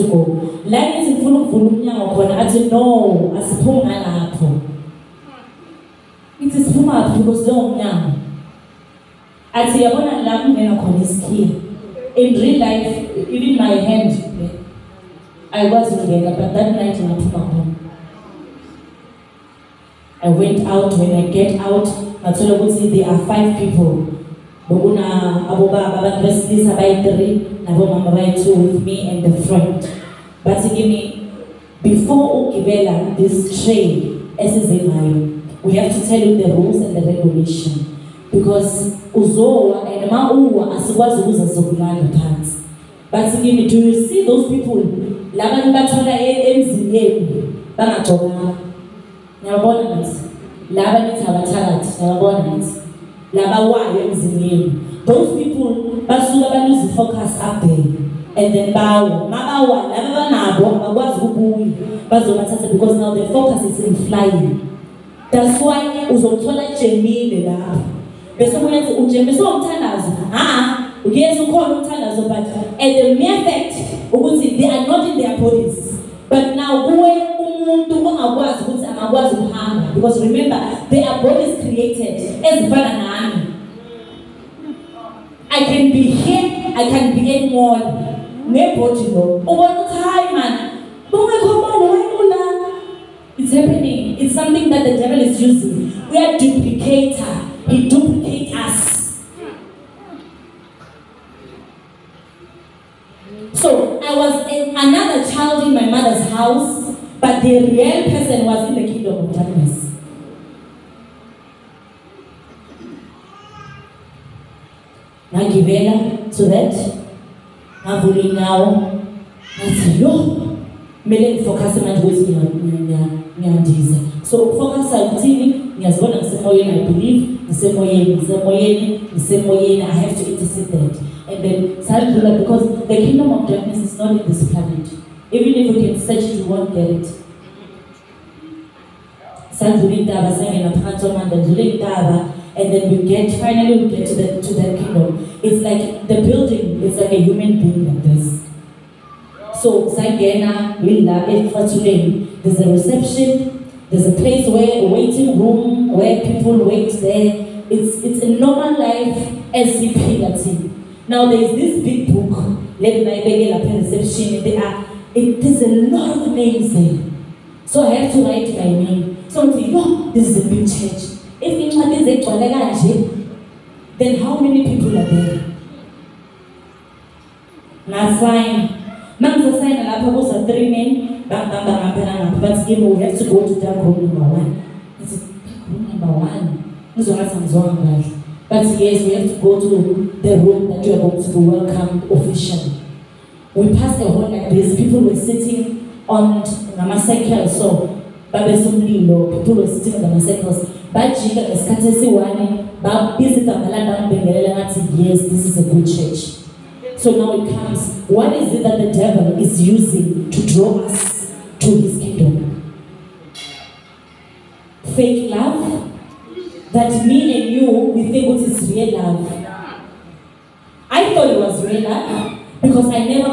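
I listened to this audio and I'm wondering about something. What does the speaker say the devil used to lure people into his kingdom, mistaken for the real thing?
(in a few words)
Fake love.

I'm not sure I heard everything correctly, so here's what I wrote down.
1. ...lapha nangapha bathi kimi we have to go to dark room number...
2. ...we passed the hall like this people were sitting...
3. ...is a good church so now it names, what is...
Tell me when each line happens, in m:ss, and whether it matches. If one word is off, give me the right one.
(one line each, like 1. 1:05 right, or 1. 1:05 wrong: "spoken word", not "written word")
1. 3:01 wrong: "ngapha", not "lapha"
2. 3:13 right
3. 3:25 wrong: "comes", not "names".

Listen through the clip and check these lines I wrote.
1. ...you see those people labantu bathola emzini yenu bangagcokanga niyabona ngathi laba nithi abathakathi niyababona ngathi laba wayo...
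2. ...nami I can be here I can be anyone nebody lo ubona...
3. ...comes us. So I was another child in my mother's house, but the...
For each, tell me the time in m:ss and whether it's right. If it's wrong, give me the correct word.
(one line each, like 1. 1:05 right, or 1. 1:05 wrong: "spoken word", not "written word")
1. 0:43 right
2. 1:22 right
3. 1:37 wrong: "duplicates", not "comes".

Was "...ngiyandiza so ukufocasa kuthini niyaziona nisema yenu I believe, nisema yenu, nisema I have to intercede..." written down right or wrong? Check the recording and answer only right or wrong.
right.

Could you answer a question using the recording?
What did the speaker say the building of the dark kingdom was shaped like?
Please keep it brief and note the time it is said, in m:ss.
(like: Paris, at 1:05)
A human being, at 2:27.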